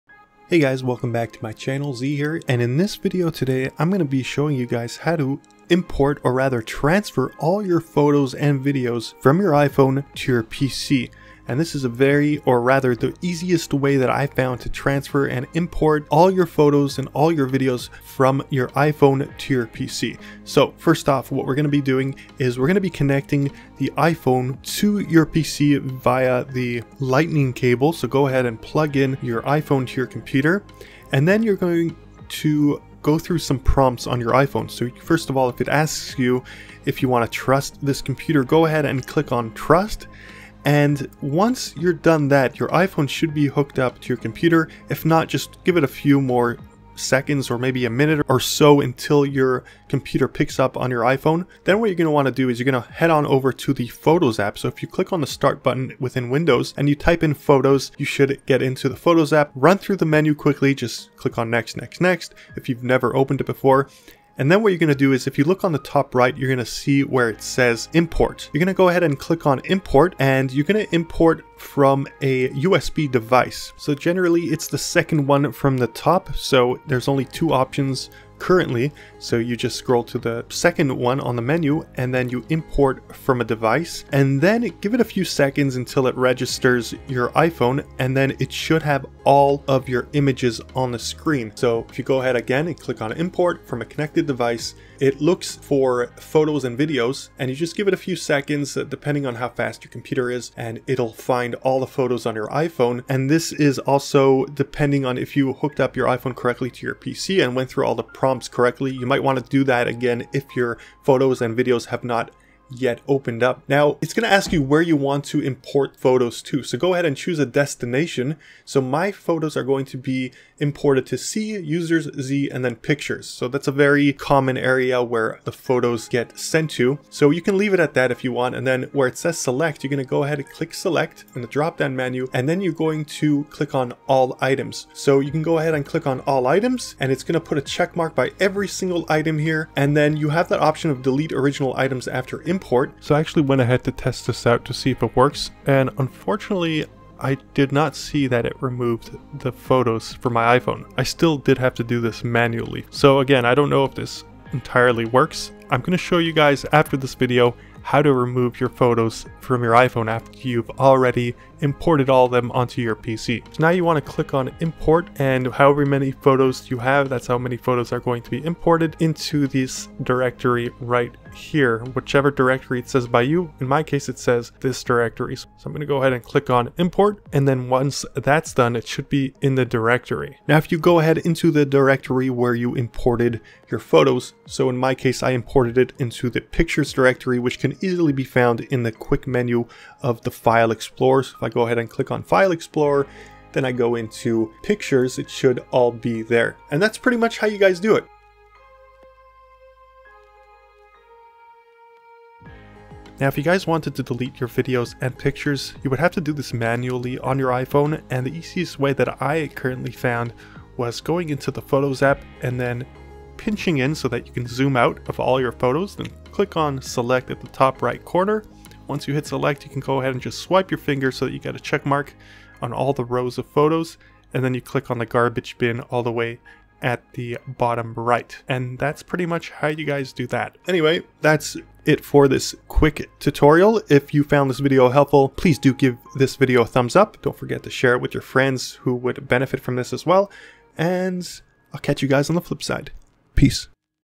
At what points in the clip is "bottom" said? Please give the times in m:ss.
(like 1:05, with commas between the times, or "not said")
3:47.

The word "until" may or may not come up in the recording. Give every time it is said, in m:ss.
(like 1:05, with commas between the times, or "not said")
0:48, 1:25.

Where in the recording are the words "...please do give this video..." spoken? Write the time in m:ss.
3:55.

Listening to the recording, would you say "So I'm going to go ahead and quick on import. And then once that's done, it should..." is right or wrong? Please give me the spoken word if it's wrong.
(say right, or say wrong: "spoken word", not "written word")
wrong: "click", not "quick".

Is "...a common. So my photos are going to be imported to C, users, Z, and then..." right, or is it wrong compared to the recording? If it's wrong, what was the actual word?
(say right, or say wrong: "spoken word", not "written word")
wrong: "destination", not "common".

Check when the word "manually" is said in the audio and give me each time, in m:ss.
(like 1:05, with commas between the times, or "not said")
2:32, 3:26.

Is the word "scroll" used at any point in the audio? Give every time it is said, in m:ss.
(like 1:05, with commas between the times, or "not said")
1:19.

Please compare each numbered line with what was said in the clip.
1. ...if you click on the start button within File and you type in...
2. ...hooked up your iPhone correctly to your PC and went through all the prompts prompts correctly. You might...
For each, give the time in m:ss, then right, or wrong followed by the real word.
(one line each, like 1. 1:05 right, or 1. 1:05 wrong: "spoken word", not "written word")
1. 0:54 wrong: "Windows", not "File"
2. 1:45 right.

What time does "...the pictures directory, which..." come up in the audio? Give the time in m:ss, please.
3:06.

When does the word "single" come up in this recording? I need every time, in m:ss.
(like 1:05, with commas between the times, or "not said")
2:18.